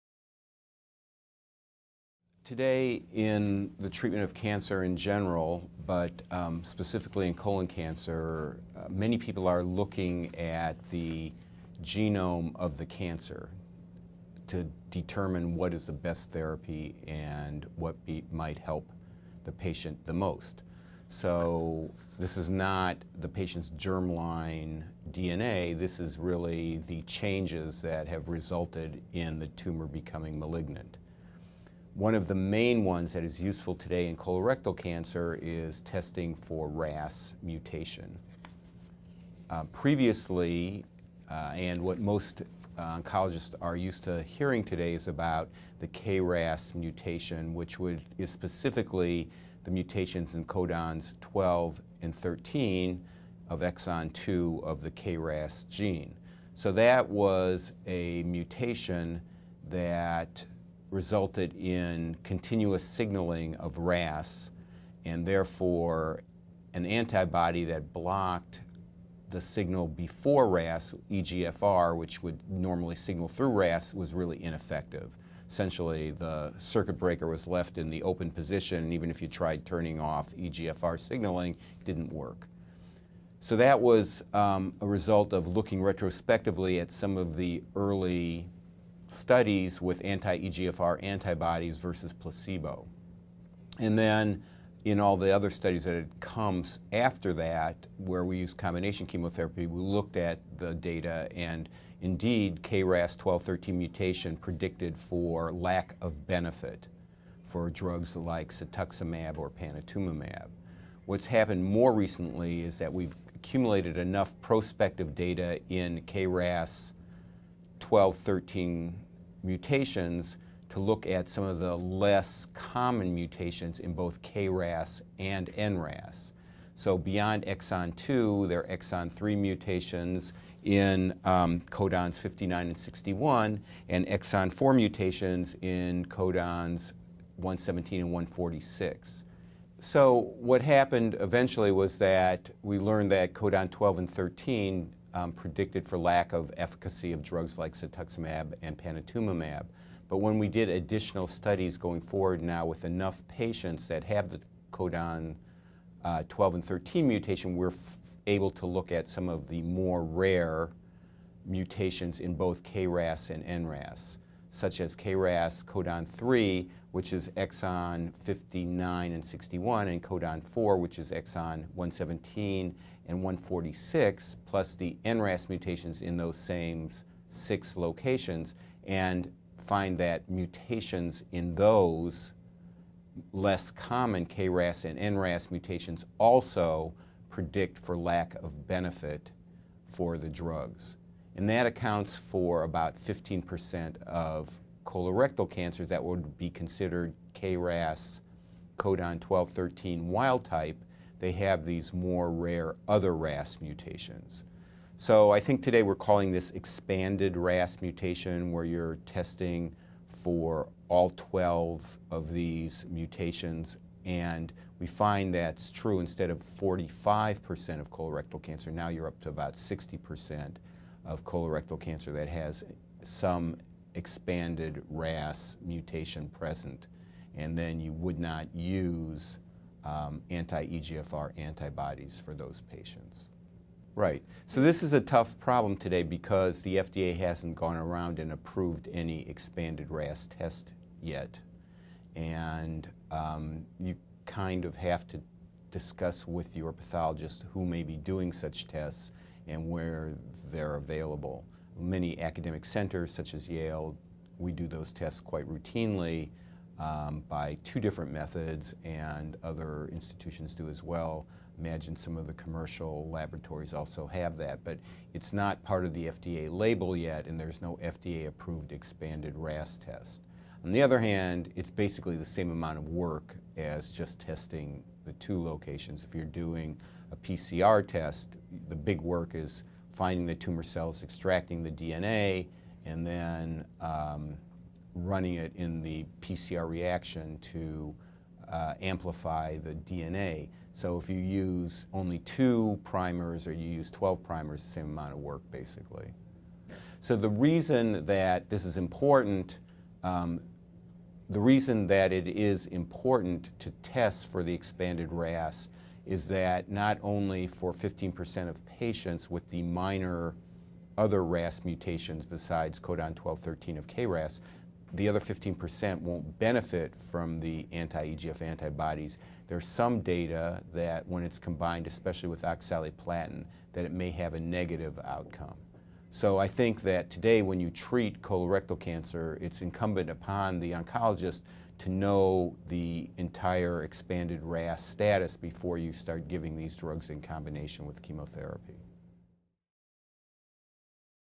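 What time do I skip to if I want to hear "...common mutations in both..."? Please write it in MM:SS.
02:02.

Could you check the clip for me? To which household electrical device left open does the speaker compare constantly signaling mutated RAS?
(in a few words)
circuit breaker.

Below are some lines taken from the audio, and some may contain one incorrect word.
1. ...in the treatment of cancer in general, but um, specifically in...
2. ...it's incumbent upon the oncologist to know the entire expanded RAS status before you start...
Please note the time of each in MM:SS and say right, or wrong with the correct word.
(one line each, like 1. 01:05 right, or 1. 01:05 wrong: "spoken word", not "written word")
1. 00:03 right
2. 05:29 right.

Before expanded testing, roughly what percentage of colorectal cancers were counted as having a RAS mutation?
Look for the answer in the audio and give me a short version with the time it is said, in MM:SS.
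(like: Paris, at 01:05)
45%, at 03:36.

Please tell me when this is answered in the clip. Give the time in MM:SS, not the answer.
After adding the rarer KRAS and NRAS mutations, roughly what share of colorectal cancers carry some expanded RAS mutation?
03:39.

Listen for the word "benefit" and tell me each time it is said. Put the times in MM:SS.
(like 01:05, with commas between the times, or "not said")
01:46, 03:08, 05:16.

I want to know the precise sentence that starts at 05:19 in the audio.
There's some data that when it's combined, especially with oxaliplatin, that it may have a negative outcome.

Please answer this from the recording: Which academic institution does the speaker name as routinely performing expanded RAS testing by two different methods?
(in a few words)
Yale.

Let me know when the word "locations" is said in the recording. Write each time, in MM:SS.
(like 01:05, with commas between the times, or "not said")
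02:57, 04:35.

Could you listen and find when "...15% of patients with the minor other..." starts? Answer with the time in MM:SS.
05:07.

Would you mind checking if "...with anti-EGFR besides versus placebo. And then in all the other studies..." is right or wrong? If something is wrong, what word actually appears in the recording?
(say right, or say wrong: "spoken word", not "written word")
wrong: "antibodies", not "besides".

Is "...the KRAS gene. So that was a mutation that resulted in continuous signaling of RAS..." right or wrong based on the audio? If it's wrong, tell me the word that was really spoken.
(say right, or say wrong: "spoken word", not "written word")
right.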